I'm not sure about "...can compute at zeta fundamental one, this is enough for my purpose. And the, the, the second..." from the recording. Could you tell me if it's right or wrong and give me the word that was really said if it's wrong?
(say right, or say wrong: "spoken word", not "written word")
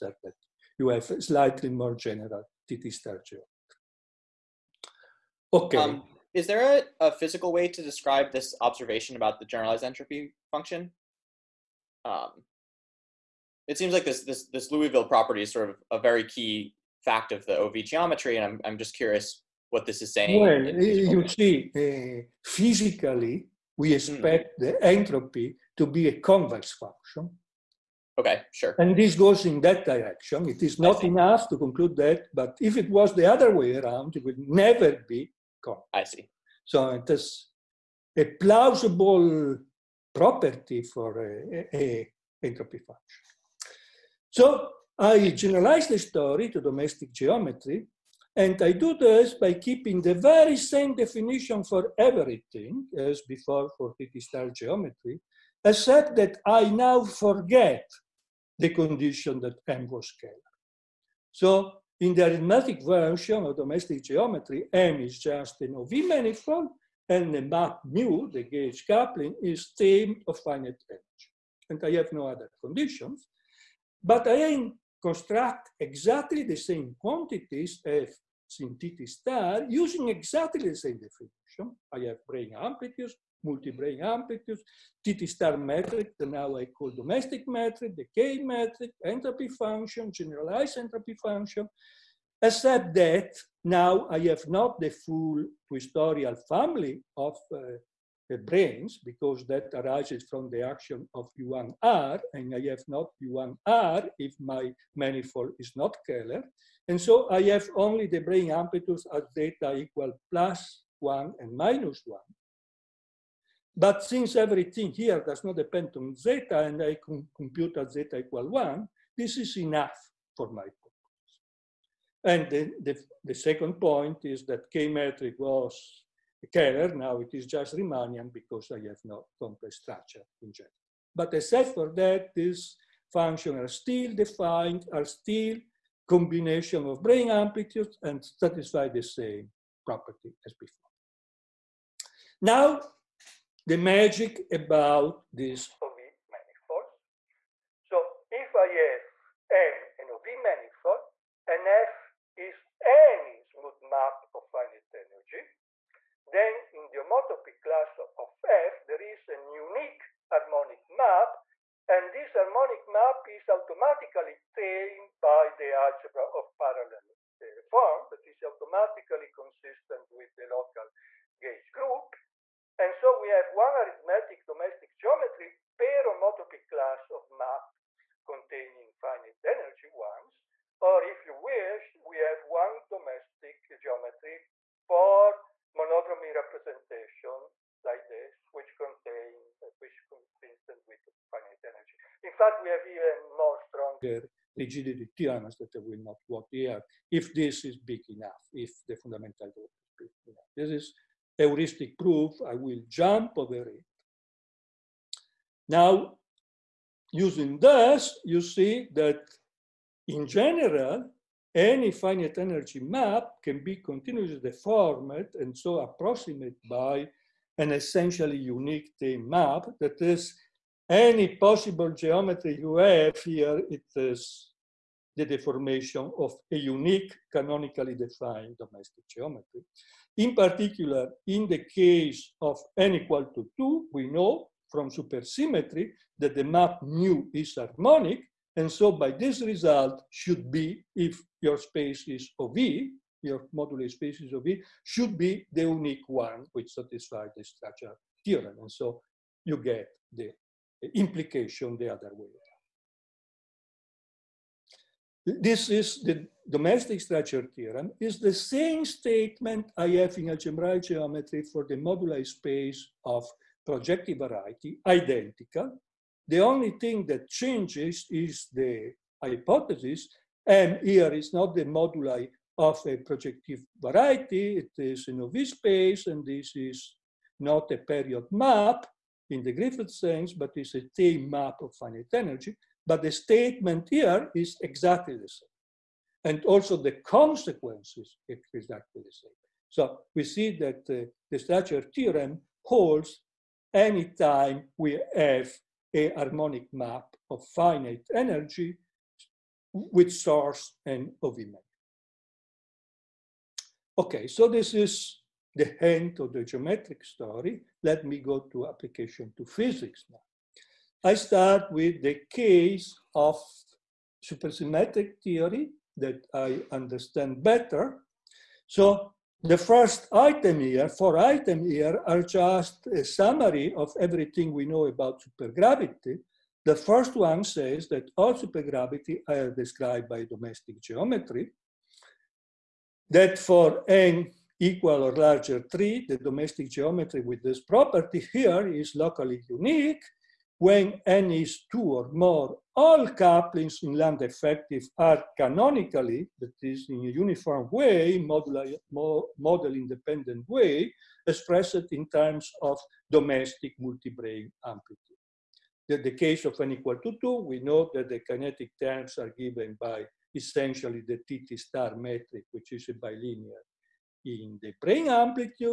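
wrong: "equal", not "fundamental".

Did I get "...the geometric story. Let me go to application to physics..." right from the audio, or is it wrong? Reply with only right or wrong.
right.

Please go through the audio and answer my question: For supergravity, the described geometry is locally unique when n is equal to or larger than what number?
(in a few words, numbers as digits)
3.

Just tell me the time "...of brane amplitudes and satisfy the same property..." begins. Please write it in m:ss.
2:16.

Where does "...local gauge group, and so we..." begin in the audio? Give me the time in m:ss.
2:50.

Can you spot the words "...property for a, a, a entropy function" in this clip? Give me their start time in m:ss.
0:40.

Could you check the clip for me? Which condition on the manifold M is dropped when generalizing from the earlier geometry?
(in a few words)
That M was scalar.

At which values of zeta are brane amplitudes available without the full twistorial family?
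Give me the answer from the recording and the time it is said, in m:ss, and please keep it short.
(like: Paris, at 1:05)
Plus one and minus one, at 1:50.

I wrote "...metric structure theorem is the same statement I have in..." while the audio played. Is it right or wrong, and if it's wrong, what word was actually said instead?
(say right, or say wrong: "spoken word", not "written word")
wrong: "domestic", not "metric".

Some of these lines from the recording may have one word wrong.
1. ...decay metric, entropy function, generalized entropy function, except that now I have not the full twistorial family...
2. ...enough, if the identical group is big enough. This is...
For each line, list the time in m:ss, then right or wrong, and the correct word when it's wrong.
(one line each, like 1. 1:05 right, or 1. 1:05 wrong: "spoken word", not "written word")
1. 1:27 right
2. 3:18 wrong: "fundamental", not "identical".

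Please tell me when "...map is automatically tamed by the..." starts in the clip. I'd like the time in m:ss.
2:42.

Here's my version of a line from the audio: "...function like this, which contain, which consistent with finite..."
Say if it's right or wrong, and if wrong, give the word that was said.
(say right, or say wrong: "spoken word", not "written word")
wrong: "representation", not "function".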